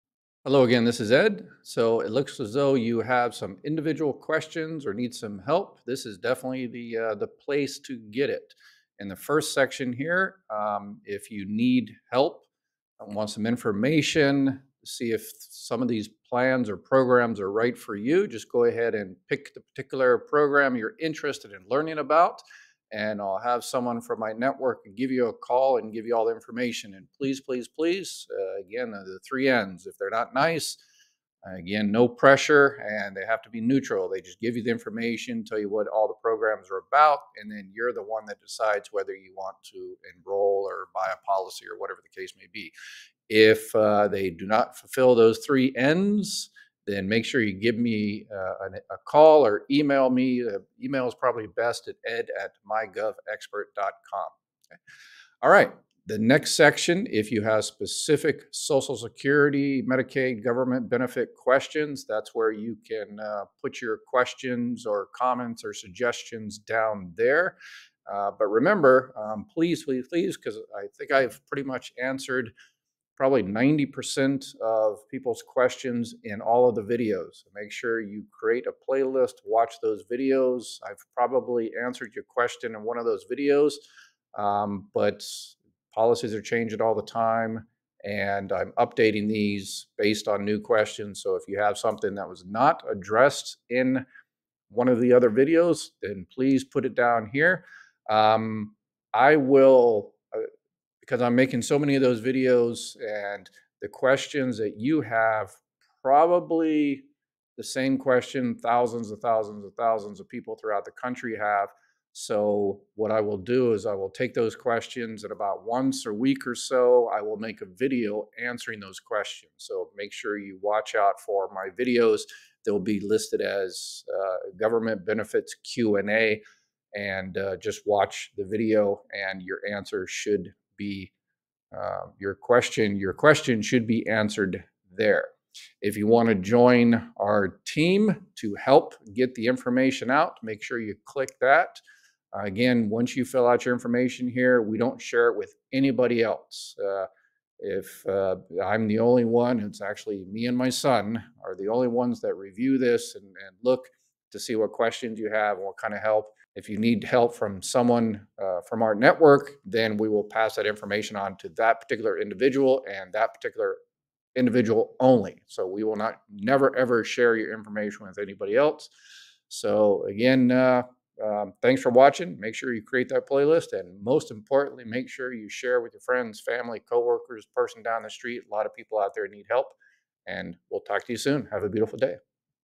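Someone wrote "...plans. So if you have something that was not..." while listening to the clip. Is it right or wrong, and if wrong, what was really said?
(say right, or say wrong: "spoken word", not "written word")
wrong: "questions", not "plans".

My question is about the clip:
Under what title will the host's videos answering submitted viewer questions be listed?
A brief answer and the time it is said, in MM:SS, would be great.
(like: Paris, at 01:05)
Government benefits Q&A, at 02:04.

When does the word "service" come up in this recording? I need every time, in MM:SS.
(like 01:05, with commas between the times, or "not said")
not said.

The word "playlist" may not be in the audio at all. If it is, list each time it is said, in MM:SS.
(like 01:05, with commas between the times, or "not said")
01:18, 02:53.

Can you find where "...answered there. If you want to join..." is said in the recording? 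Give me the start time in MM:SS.
02:14.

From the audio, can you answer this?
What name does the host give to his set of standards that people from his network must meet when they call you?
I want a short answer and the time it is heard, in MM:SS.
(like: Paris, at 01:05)
The three N's, at 00:28.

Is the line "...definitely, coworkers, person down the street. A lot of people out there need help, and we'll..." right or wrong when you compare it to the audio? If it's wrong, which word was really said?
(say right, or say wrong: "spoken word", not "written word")
wrong: "family", not "definitely".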